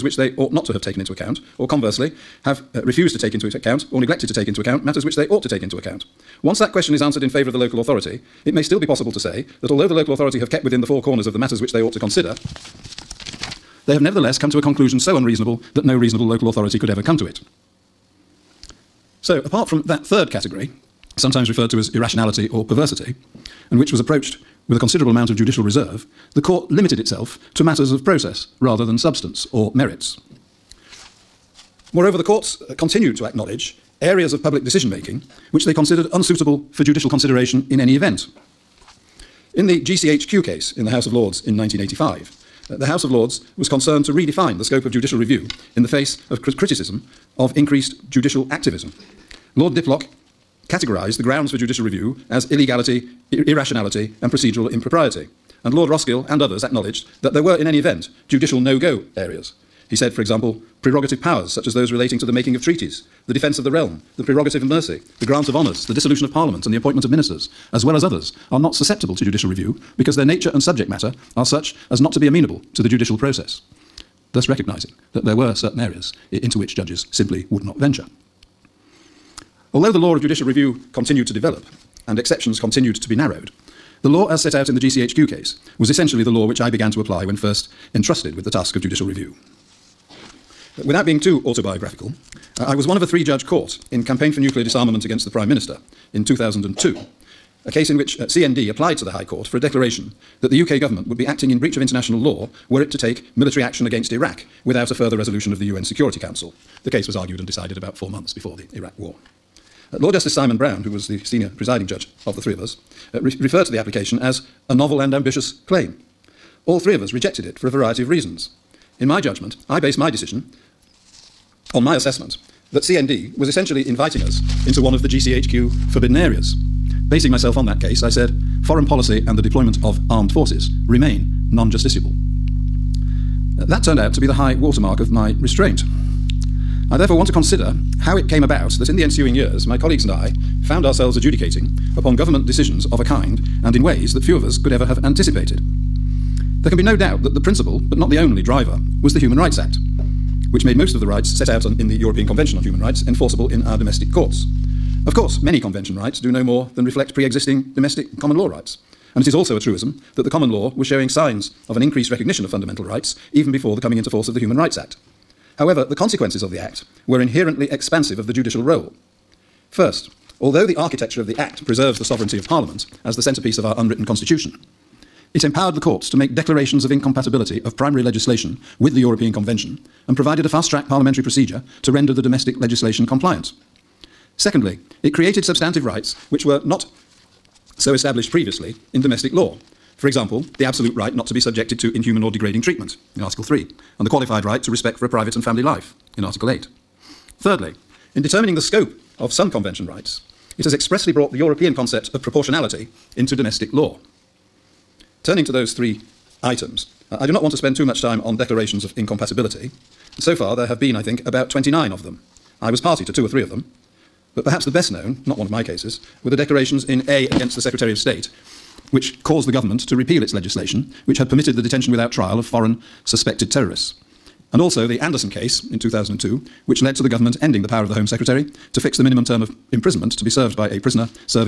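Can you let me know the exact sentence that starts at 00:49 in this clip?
Lord Diplock categorised the grounds for judicial review as illegality, ir irrationality, and procedural impropriety.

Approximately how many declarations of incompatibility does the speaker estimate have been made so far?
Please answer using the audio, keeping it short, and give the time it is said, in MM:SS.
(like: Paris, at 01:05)
29, at 03:31.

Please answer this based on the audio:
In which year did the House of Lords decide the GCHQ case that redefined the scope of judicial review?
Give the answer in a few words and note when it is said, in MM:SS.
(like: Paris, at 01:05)
1985, at 00:41.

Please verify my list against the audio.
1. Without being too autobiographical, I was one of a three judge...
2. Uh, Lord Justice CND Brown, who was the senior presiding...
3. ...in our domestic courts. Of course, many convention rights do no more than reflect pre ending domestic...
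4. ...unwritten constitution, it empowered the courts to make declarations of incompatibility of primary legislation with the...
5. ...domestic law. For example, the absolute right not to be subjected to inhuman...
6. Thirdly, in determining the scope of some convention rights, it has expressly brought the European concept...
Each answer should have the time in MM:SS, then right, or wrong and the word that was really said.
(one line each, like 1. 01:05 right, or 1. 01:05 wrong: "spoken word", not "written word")
1. 01:30 right
2. 01:49 wrong: "Simon", not "CND"
3. 02:33 wrong: "existing", not "ending"
4. 02:53 right
5. 03:09 right
6. 03:17 right.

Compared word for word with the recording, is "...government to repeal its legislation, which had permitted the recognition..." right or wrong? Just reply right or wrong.
wrong.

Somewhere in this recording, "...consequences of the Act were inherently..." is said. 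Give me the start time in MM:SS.
02:45.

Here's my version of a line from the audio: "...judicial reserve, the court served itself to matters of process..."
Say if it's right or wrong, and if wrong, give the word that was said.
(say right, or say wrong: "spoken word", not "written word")
wrong: "limited", not "served".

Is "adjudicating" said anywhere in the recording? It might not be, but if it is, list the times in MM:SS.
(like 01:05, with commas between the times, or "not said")
02:21.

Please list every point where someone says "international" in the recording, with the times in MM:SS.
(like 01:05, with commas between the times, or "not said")
01:41.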